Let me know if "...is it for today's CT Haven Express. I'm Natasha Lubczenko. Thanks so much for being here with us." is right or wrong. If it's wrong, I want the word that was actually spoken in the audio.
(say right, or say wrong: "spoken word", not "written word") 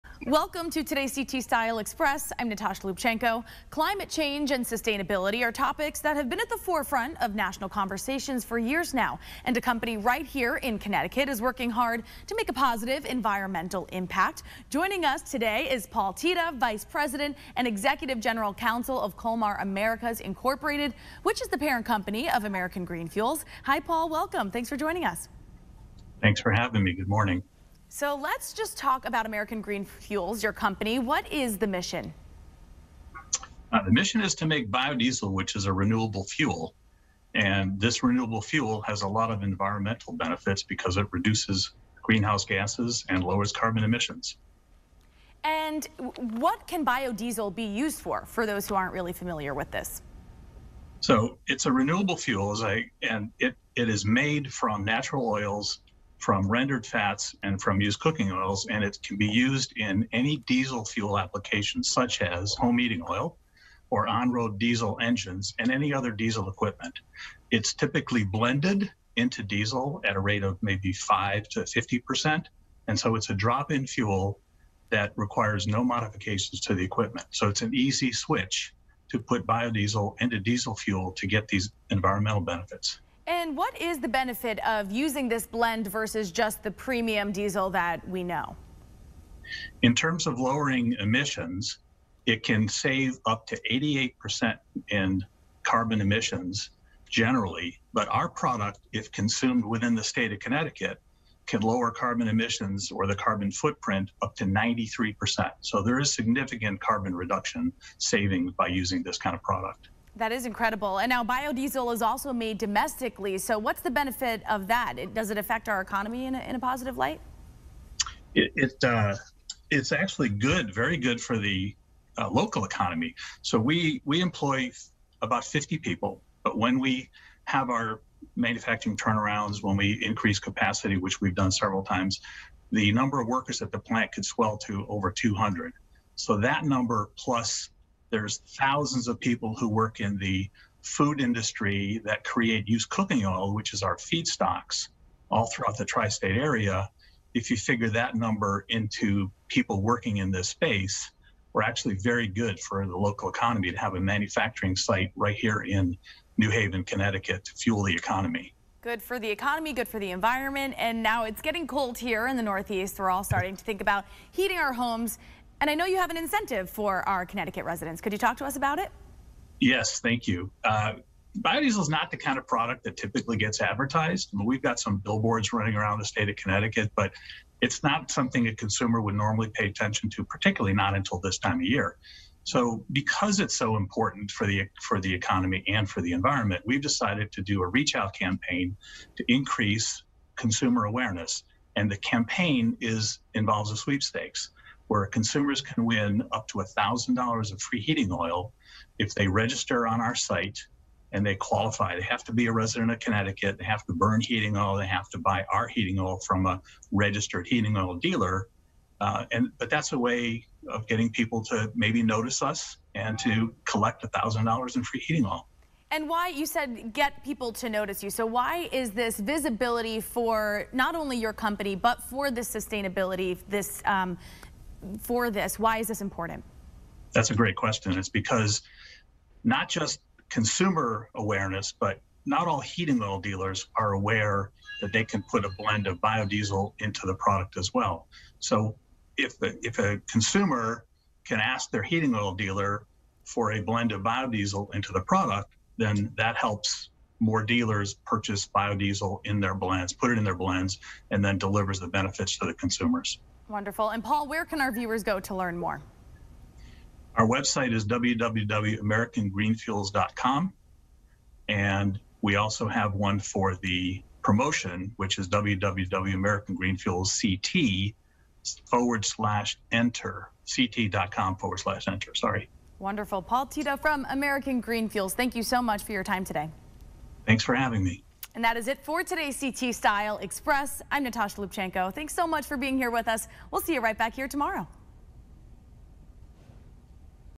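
wrong: "Style", not "Haven".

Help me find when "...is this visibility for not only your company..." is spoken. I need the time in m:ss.
3:38.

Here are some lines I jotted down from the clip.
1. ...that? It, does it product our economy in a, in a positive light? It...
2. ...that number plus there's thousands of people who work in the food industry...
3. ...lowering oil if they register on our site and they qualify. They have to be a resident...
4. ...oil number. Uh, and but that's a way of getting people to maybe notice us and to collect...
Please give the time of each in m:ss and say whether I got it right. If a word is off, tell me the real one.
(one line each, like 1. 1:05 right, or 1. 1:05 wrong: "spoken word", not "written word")
1. 1:54 wrong: "affect", not "product"
2. 2:16 right
3. 3:17 wrong: "heating", not "lowering"
4. 3:27 wrong: "dealer", not "number".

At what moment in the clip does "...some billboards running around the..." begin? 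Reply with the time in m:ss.
2:54.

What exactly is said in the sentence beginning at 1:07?
It's typically blended into diesel at a rate of maybe 5 to 50%.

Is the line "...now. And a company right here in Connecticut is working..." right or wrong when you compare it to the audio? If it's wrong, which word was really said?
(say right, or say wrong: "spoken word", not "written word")
right.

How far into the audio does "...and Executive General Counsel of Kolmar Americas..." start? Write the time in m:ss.
0:17.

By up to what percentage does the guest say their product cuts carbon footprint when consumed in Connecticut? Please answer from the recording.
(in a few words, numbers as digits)
93%.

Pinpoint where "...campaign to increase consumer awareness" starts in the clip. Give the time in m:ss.
3:08.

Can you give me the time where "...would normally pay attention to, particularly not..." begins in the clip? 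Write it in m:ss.
2:59.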